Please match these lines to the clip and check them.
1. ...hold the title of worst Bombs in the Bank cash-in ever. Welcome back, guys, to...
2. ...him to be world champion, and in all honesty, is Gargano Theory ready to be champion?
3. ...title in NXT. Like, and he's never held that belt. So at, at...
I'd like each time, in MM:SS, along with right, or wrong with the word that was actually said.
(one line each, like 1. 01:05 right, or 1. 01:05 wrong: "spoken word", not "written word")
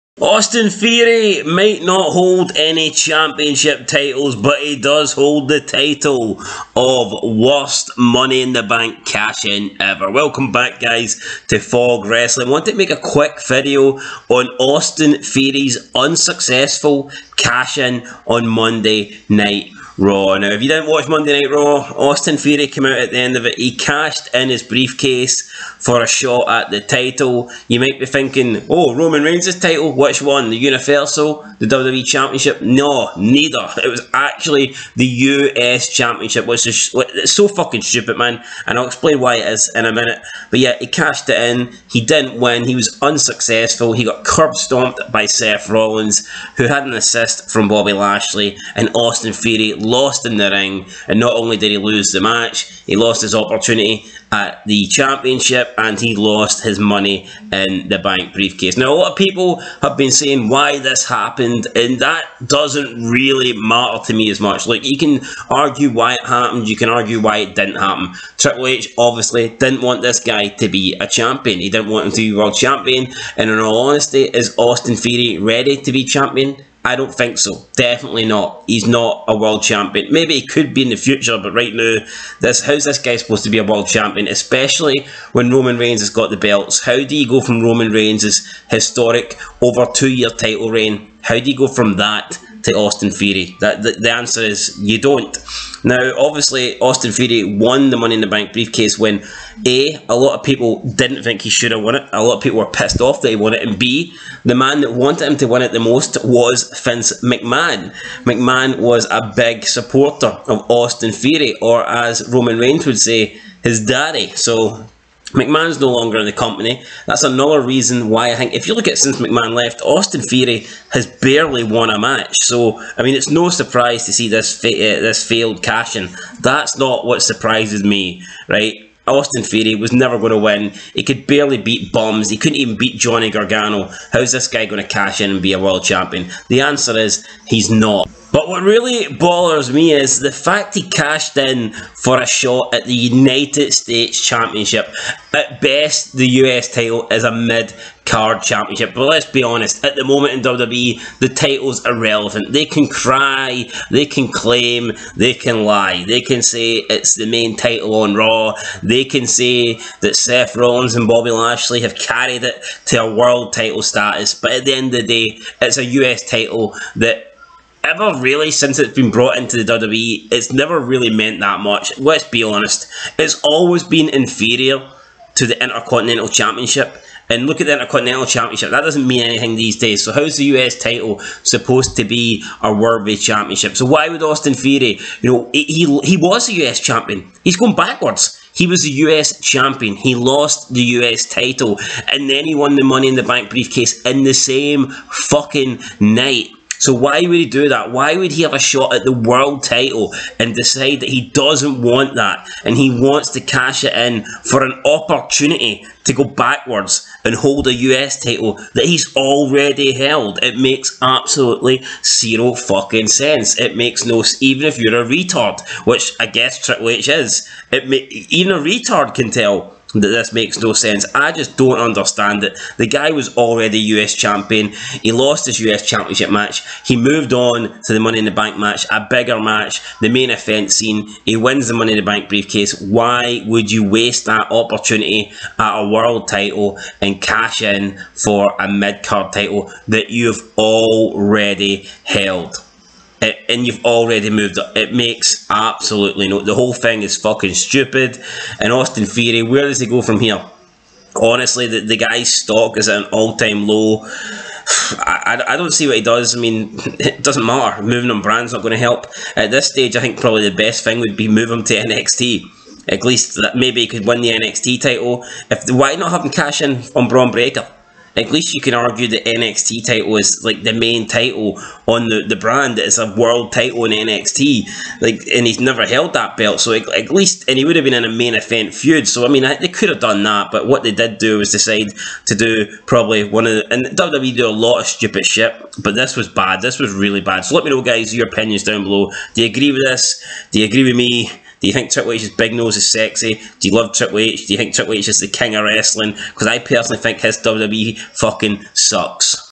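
1. 00:05 wrong: "Money", not "Bombs"
2. 01:12 wrong: "Austin", not "Gargano"
3. 04:33 right.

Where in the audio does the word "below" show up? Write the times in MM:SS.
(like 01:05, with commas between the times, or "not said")
04:48.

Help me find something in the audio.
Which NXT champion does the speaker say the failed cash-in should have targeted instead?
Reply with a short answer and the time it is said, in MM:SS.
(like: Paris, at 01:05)
Bron Breakker, at 04:27.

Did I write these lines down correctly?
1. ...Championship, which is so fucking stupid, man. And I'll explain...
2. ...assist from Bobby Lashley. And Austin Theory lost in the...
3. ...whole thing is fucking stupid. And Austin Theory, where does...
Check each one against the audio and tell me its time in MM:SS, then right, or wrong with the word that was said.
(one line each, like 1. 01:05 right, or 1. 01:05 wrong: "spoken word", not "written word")
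1. 00:35 right
2. 00:46 right
3. 04:06 right.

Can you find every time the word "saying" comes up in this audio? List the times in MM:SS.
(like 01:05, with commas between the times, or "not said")
01:00.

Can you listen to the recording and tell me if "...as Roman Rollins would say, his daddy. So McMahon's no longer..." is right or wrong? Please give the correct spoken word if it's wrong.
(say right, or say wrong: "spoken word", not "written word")
wrong: "Reigns", not "Rollins".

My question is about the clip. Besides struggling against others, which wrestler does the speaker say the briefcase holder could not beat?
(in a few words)
Johnny Gargano.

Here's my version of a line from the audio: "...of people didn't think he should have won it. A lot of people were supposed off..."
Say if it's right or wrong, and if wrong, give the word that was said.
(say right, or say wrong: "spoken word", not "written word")
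wrong: "pissed", not "supposed".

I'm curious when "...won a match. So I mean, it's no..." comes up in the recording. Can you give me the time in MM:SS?
02:01.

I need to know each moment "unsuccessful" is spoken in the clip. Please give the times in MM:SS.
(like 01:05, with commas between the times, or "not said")
00:15, 00:43.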